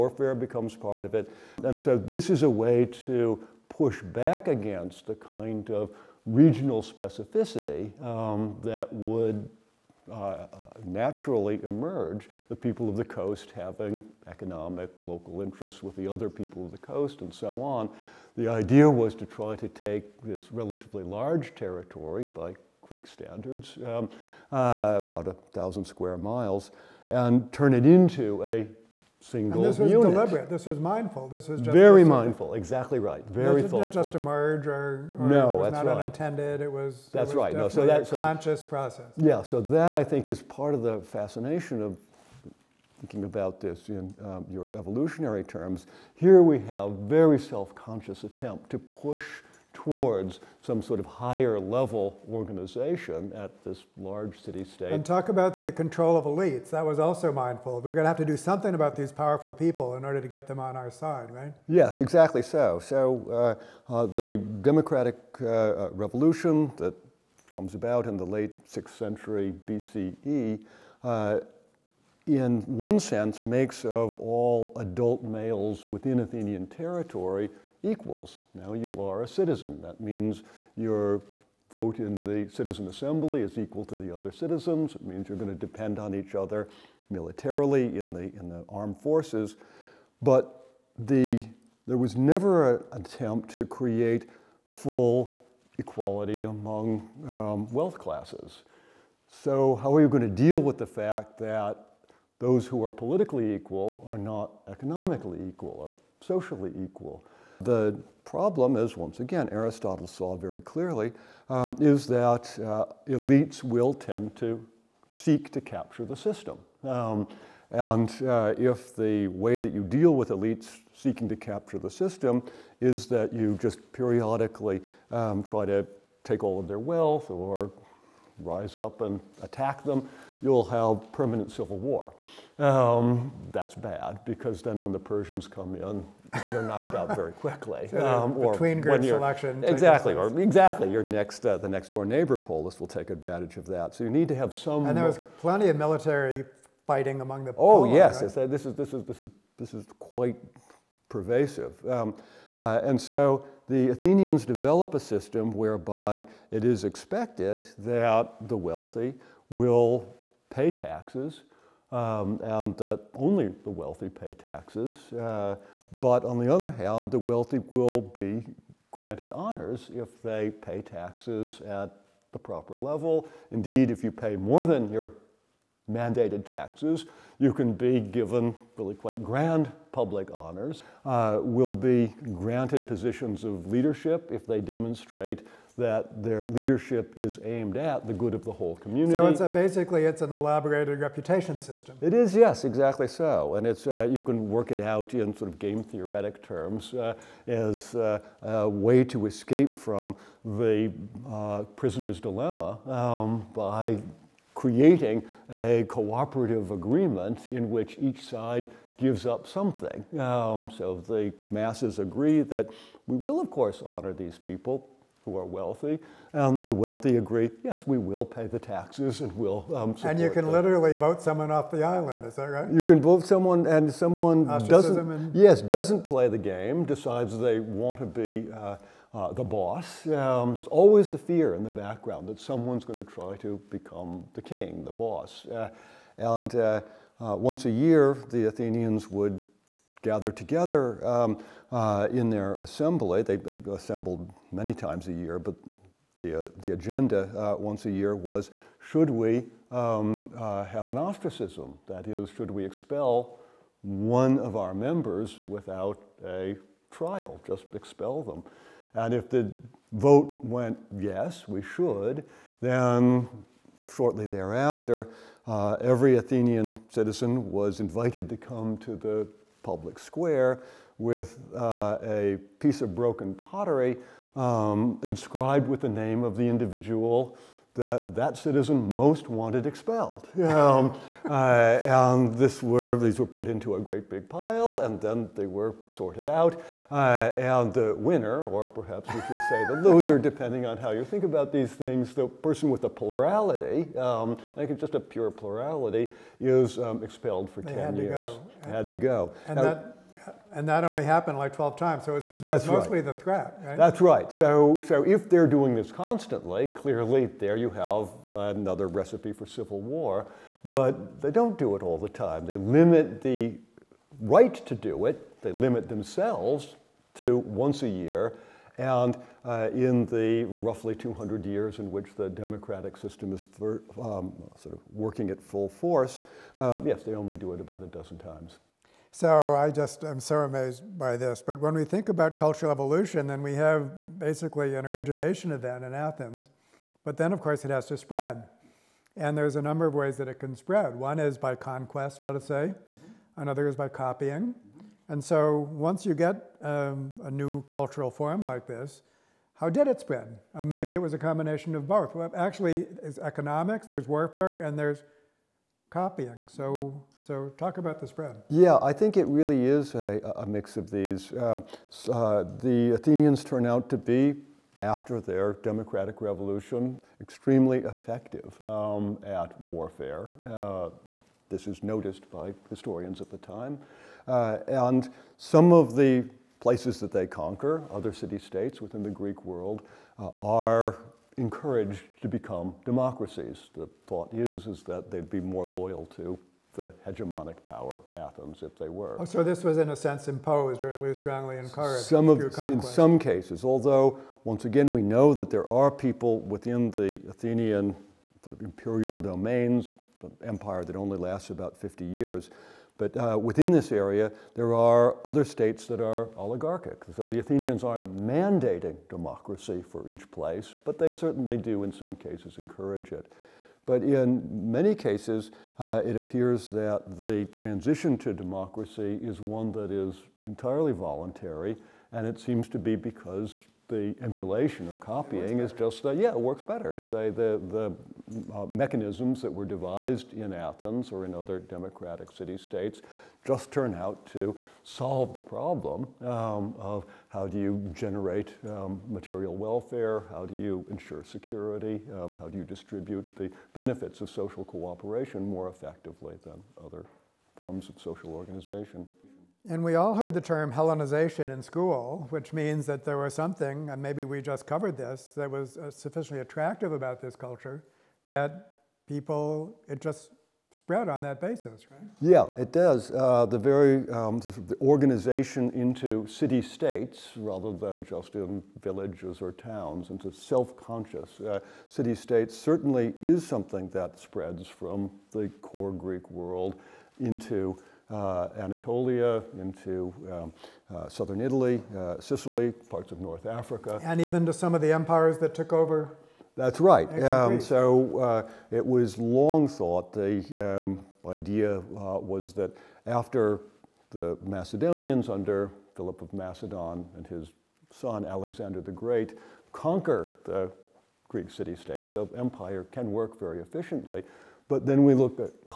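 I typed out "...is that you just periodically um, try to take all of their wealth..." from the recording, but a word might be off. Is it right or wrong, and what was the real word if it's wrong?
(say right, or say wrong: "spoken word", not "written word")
right.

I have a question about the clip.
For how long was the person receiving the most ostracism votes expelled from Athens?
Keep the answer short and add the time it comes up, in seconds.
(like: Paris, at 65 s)
10 years, at 297 s.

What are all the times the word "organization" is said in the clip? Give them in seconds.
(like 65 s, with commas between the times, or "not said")
52 s, 448 s, 464 s.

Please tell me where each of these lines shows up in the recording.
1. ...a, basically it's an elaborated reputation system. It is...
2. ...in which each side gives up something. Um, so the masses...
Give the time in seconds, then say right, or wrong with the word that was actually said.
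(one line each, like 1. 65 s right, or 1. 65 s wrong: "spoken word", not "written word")
1. 189 s right
2. 207 s right.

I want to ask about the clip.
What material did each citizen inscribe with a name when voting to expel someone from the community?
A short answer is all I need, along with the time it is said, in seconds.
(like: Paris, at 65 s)
broken pottery, at 272 s.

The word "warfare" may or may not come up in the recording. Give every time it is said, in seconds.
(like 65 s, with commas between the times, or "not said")
354 s, 369 s.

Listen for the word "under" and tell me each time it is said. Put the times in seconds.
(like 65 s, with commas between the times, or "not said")
495 s.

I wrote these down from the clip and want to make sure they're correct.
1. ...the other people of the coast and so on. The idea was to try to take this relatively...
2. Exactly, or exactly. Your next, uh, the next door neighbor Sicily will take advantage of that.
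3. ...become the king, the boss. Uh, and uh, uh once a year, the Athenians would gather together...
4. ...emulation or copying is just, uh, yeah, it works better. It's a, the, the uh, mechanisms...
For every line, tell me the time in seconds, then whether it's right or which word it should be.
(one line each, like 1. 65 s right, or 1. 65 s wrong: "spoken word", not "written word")
1. 15 s right
2. 139 s wrong: "Polis", not "Sicily"
3. 233 s right
4. 424 s right.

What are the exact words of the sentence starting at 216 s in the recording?
And um, the wealthy agree, yes, we will pay the taxes and we'll um, And you can them.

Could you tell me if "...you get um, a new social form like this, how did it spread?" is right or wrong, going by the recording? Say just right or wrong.
wrong.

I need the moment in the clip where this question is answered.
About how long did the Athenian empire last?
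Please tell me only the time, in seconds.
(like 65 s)
401 s.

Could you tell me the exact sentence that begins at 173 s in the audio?
Indeed, if you pay more than your mandated taxes.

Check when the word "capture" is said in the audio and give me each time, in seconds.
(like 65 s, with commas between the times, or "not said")
115 s, 121 s.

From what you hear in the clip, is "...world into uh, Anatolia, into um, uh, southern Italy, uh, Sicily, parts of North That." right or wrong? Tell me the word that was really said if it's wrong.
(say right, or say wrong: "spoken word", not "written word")
wrong: "Africa", not "That".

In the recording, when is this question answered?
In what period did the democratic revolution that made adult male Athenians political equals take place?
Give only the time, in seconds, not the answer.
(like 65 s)
68 s.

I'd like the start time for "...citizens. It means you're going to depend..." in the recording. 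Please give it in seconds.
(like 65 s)
84 s.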